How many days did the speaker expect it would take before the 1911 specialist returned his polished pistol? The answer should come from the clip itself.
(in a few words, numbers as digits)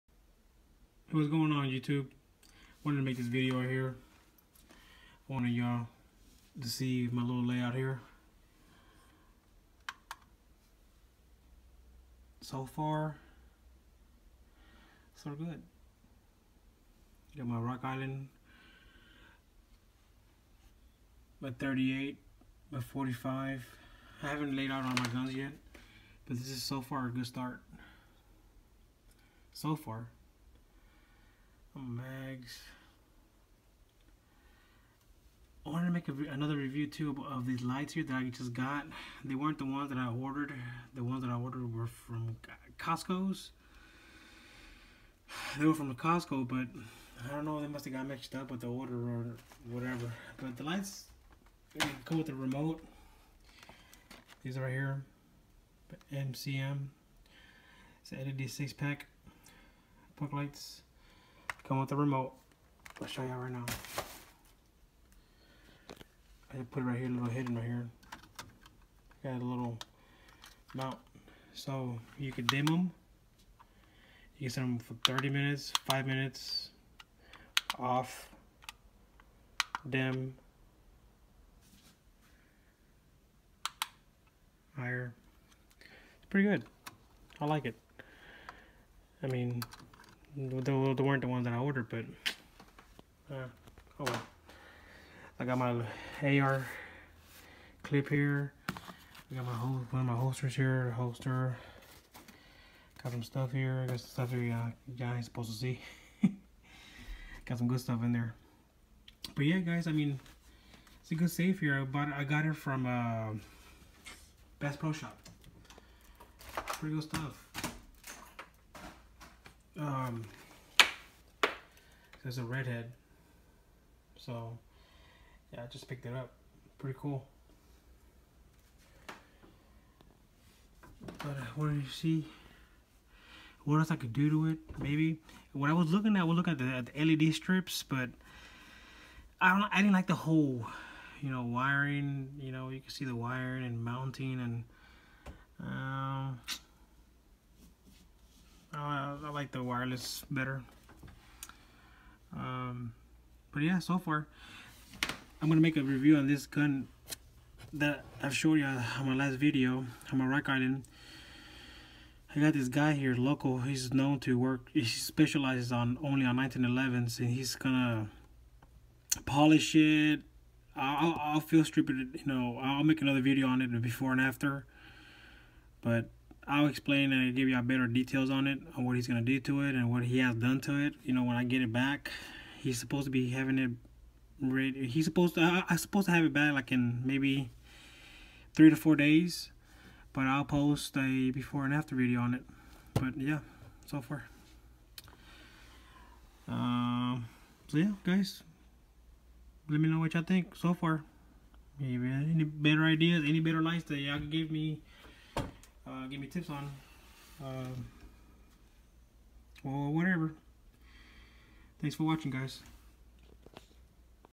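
3 to 4 days.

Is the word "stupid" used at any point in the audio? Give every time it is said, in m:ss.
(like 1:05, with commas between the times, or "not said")
2:51.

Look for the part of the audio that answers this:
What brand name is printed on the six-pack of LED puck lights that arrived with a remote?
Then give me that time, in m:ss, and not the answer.
0:56.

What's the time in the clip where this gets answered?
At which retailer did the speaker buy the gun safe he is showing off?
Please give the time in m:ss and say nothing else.
1:54.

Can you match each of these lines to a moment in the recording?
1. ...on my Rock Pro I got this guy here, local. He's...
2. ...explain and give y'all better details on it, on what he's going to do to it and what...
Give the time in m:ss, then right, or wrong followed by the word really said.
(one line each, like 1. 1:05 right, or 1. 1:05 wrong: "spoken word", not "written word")
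1. 2:40 wrong: "And", not "Pro"
2. 2:56 right.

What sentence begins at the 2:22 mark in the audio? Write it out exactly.
You know, you can see the wiring and mounting and.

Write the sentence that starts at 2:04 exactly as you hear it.
So, yeah, I just picked it up.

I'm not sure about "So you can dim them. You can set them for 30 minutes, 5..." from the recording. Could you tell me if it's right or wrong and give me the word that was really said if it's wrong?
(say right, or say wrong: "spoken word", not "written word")
right.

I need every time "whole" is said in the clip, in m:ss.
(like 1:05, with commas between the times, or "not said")
1:39, 2:20.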